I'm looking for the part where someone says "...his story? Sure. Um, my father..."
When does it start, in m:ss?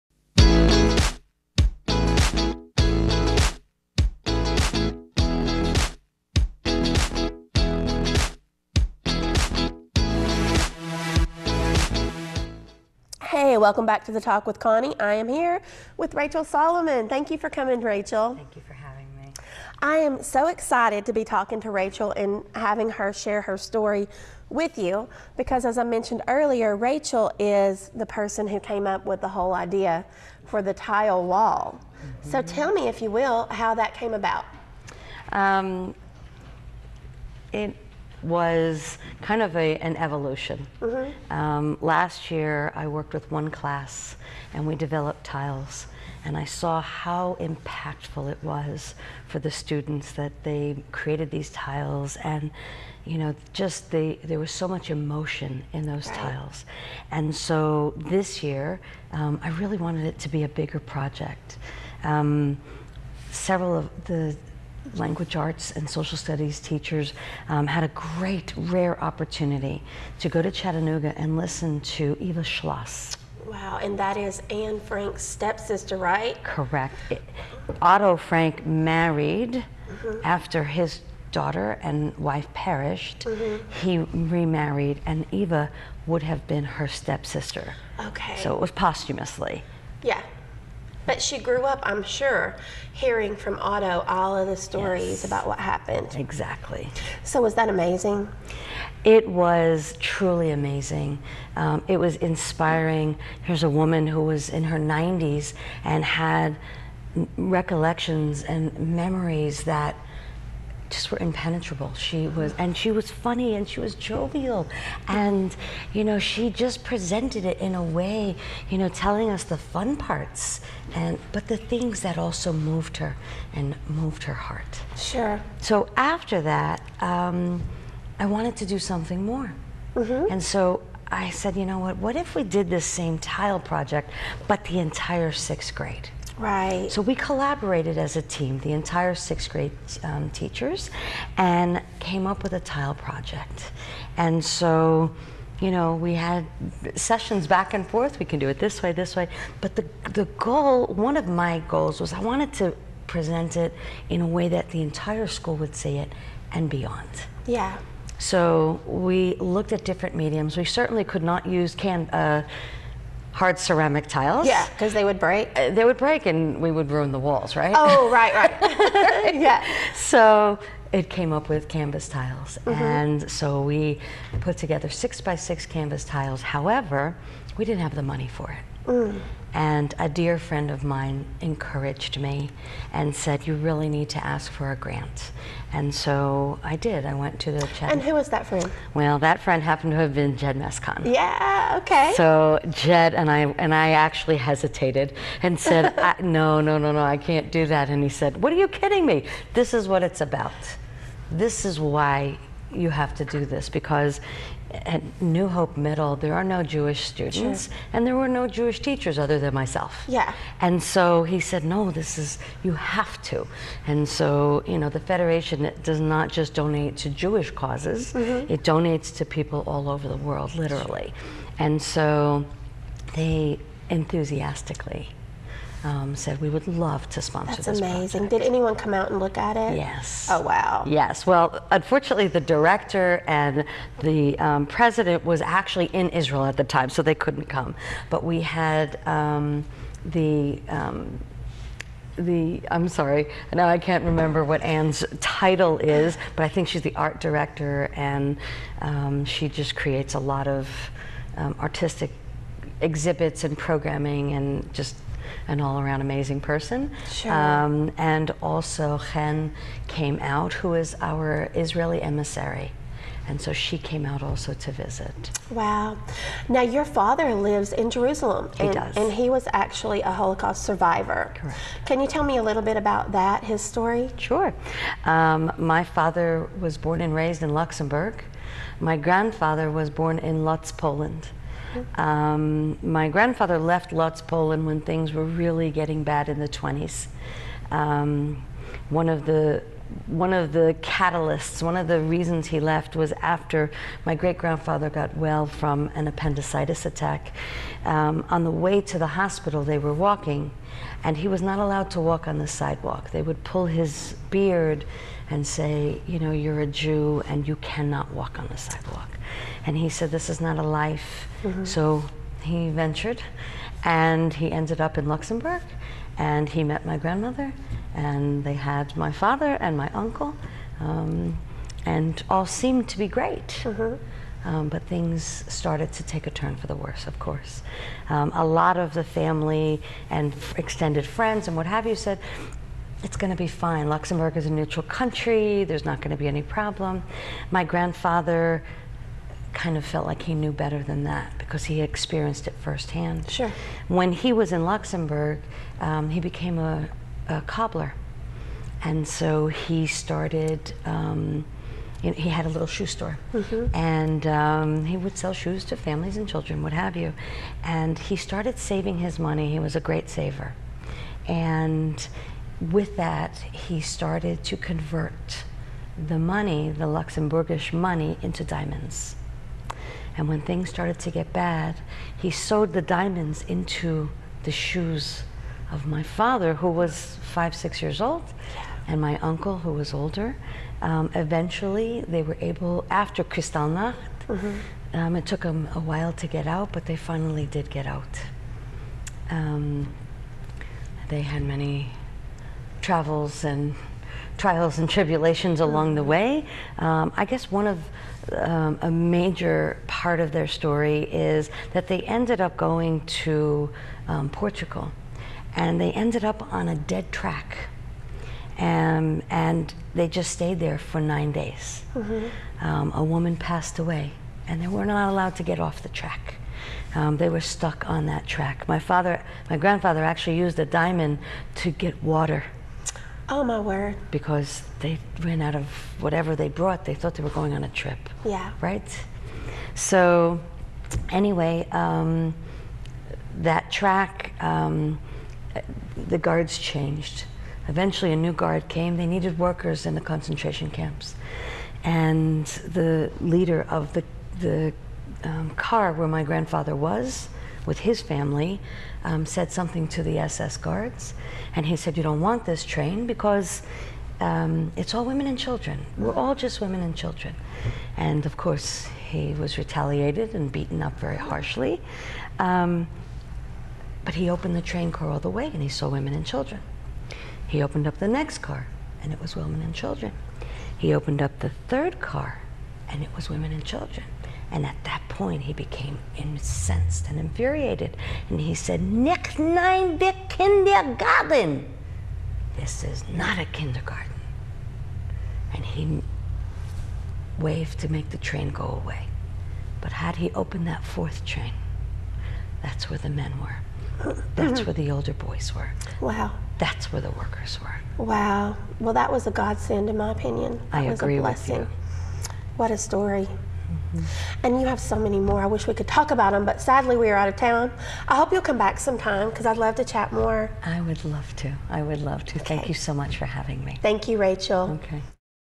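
4:33.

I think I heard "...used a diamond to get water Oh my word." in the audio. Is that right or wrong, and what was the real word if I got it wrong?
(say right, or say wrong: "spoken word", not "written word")
right.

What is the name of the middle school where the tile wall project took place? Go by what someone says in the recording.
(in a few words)
New Hope Middle.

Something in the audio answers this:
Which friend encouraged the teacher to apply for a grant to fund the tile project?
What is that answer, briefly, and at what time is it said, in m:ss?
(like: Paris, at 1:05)
Jed Mescon, at 3:10.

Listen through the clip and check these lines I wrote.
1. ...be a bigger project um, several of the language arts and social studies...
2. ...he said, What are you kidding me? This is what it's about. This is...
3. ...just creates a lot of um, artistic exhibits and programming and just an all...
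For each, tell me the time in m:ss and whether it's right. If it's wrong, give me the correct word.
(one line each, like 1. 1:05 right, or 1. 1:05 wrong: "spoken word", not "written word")
1. 1:00 right
2. 3:18 right
3. 4:09 right.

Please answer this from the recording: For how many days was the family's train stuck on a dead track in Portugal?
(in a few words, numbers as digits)
9.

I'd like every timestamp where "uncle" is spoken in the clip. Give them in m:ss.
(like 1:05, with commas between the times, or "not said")
5:19, 6:19.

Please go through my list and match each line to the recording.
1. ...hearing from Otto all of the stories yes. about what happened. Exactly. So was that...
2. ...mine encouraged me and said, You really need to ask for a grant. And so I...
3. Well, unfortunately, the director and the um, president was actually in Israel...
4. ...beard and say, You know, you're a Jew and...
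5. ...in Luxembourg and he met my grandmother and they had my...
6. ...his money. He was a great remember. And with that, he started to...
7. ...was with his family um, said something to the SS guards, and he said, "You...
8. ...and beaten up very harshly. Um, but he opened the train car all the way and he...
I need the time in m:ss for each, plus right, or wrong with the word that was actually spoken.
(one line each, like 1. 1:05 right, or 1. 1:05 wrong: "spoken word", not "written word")
1. 1:32 right
2. 3:00 right
3. 3:51 right
4. 5:04 right
5. 5:14 right
6. 5:59 wrong: "saver", not "remember"
7. 7:26 right
8. 7:40 right.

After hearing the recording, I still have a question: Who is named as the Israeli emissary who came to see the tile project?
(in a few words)
Chen.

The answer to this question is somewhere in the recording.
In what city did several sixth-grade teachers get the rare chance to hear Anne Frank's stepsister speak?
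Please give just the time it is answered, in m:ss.
1:10.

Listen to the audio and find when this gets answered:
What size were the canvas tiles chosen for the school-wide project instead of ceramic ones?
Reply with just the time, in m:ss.
2:54.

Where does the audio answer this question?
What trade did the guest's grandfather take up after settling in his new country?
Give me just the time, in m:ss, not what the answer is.
5:47.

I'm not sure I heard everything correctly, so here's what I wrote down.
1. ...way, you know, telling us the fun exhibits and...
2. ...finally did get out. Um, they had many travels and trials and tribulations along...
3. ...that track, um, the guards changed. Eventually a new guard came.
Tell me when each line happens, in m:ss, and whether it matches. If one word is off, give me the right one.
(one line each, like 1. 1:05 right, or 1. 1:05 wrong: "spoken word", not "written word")
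1. 1:57 wrong: "parts", not "exhibits"
2. 6:26 right
3. 7:13 right.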